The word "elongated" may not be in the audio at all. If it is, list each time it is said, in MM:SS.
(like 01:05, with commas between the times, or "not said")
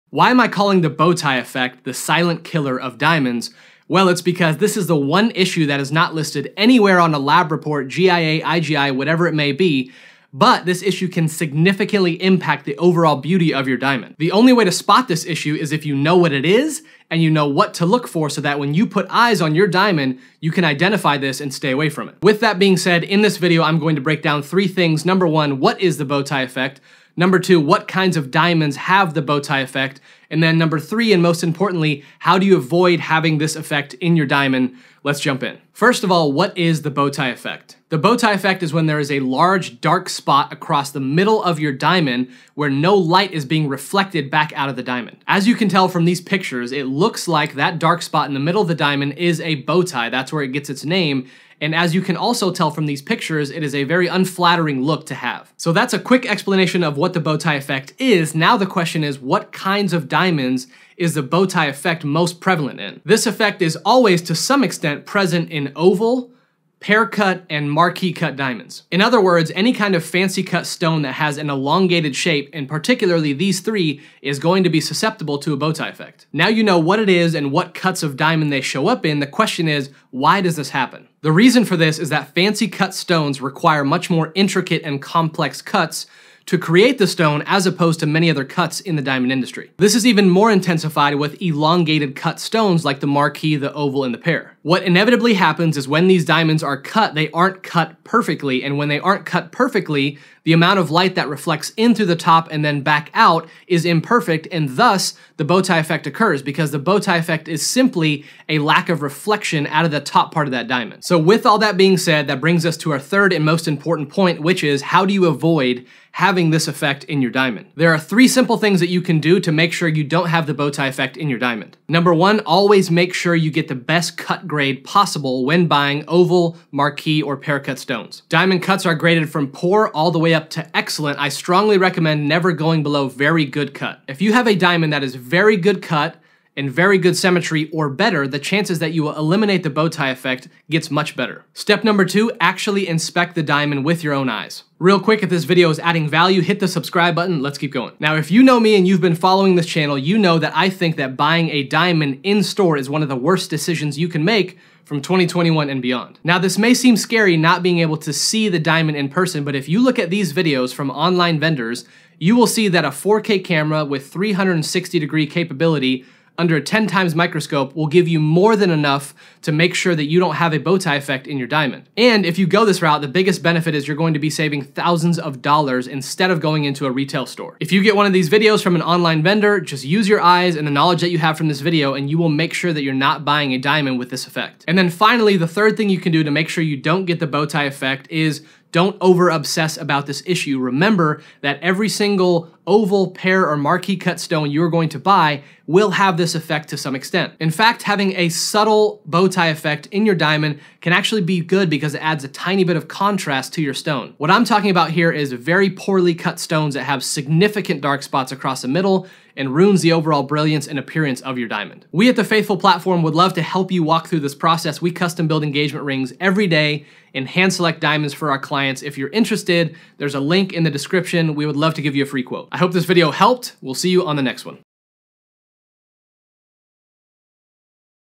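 01:11, 01:31.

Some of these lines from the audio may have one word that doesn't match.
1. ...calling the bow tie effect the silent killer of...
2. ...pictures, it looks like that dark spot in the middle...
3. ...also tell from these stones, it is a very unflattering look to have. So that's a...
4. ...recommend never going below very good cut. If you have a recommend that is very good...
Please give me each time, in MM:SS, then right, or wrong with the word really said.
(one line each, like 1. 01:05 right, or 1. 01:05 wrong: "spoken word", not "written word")
1. 00:00 right
2. 00:46 right
3. 00:52 wrong: "pictures", not "stones"
4. 02:11 wrong: "diamond", not "recommend".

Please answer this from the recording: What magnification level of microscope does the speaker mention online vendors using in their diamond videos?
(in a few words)
10 times.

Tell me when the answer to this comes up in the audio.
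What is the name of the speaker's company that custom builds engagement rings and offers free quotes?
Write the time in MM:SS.
03:32.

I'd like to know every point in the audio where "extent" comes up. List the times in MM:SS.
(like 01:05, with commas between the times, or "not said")
01:04, 03:16.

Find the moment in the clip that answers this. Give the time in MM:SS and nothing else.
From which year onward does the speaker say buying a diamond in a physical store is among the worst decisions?
02:35.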